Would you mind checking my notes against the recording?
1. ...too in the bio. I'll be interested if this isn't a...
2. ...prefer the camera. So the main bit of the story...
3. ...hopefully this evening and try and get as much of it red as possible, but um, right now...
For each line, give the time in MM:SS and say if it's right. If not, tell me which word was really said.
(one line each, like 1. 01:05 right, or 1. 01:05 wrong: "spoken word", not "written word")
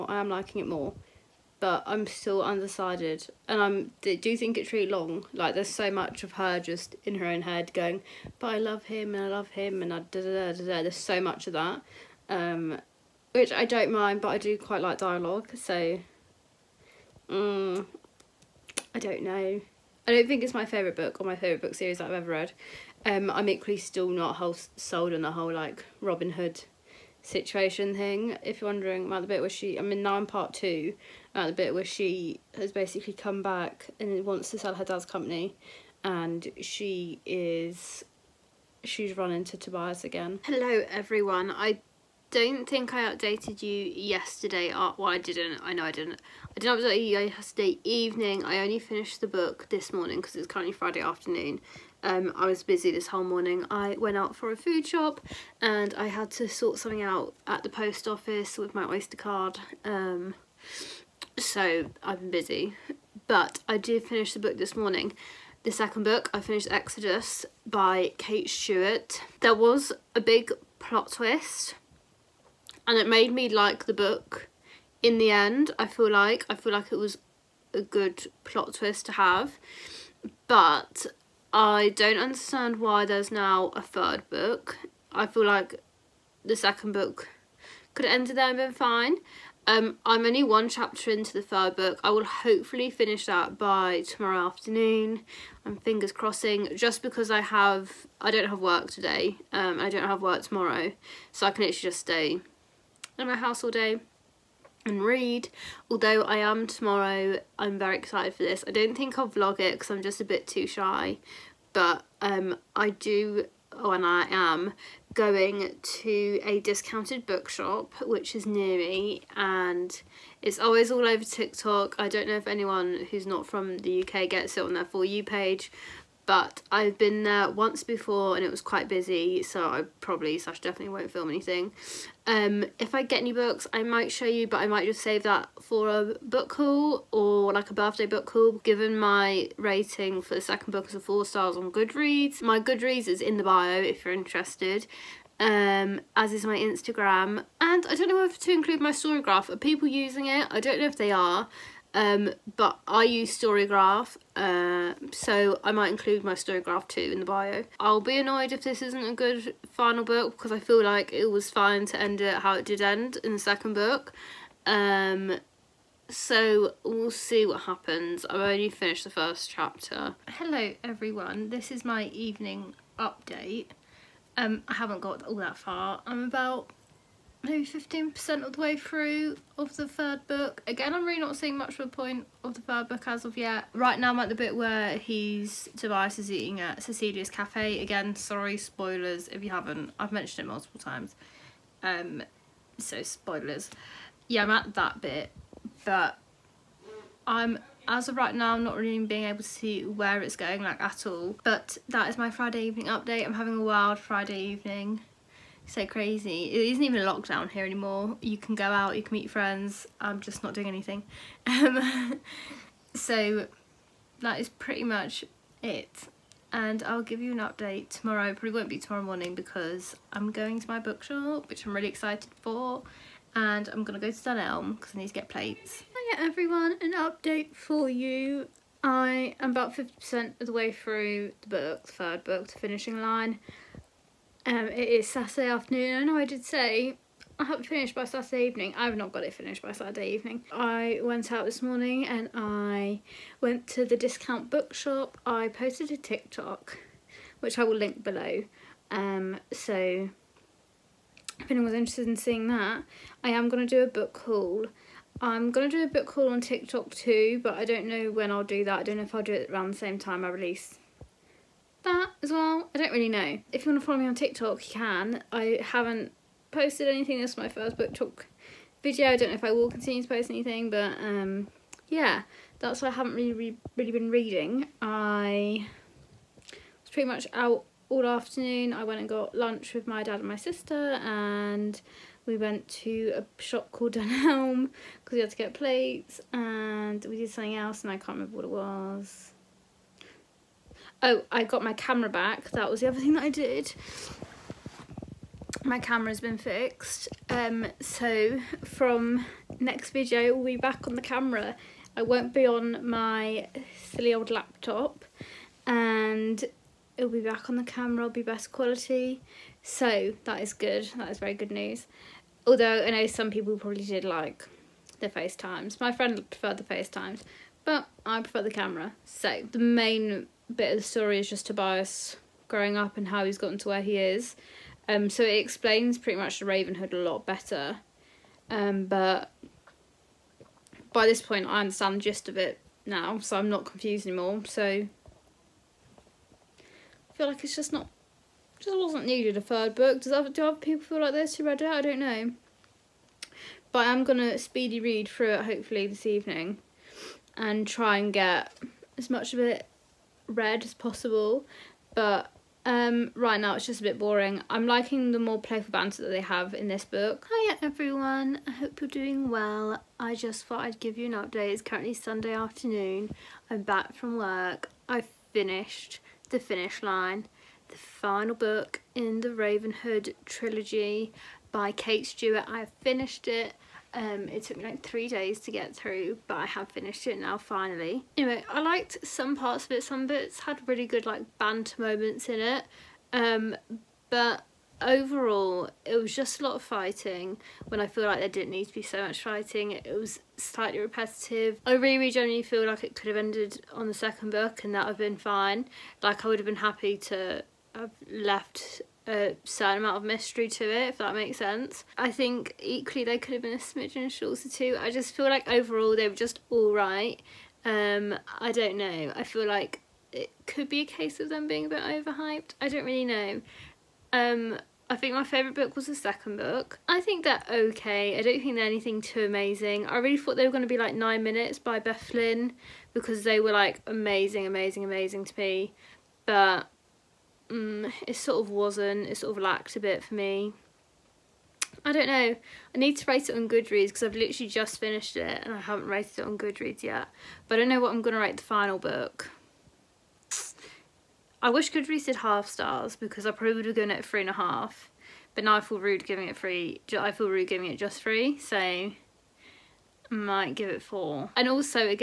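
1. 02:36 wrong: "annoyed", not "interested"
2. 05:18 right
3. 05:45 right.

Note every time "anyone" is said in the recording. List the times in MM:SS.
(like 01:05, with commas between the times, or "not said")
02:02, 04:11.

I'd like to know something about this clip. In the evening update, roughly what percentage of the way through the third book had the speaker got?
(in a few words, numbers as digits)
15%.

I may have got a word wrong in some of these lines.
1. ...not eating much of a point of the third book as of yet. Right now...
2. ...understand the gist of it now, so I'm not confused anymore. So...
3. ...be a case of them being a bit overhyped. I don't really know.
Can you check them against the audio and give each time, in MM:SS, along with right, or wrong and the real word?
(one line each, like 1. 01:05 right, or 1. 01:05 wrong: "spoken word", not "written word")
1. 03:01 wrong: "seeing", not "eating"
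2. 05:31 right
3. 06:50 right.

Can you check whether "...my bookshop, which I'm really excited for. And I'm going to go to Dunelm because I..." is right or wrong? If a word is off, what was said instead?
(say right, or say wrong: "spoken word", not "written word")
right.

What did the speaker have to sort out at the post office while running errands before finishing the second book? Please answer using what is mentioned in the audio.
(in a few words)
Oyster card.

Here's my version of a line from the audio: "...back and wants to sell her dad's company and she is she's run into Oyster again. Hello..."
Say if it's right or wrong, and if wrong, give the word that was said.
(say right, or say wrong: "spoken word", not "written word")
wrong: "Tobias", not "Oyster".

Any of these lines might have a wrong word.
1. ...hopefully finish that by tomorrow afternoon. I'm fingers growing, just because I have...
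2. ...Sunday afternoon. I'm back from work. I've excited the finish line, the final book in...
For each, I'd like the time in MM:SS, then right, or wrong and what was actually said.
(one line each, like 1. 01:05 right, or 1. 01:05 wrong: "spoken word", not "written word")
1. 01:32 wrong: "crossing", not "growing"
2. 06:01 wrong: "finished", not "excited".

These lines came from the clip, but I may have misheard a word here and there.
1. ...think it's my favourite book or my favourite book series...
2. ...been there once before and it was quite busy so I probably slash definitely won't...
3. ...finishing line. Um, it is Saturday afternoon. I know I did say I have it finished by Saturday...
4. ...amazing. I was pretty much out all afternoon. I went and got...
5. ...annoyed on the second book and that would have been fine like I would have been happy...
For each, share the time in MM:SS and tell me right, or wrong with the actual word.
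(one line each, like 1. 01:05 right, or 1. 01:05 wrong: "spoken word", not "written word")
1. 00:20 right
2. 02:06 right
3. 03:52 right
4. 04:34 wrong: "reading", not "amazing"
5. 06:33 wrong: "ended", not "annoyed".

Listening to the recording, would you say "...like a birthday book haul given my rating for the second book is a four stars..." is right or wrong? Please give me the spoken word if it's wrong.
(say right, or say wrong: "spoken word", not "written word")
right.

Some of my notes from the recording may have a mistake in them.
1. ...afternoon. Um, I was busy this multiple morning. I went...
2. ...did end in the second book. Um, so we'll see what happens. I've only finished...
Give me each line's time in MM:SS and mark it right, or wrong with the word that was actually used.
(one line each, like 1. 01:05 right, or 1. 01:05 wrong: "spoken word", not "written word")
1. 00:50 wrong: "whole", not "multiple"
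2. 02:42 right.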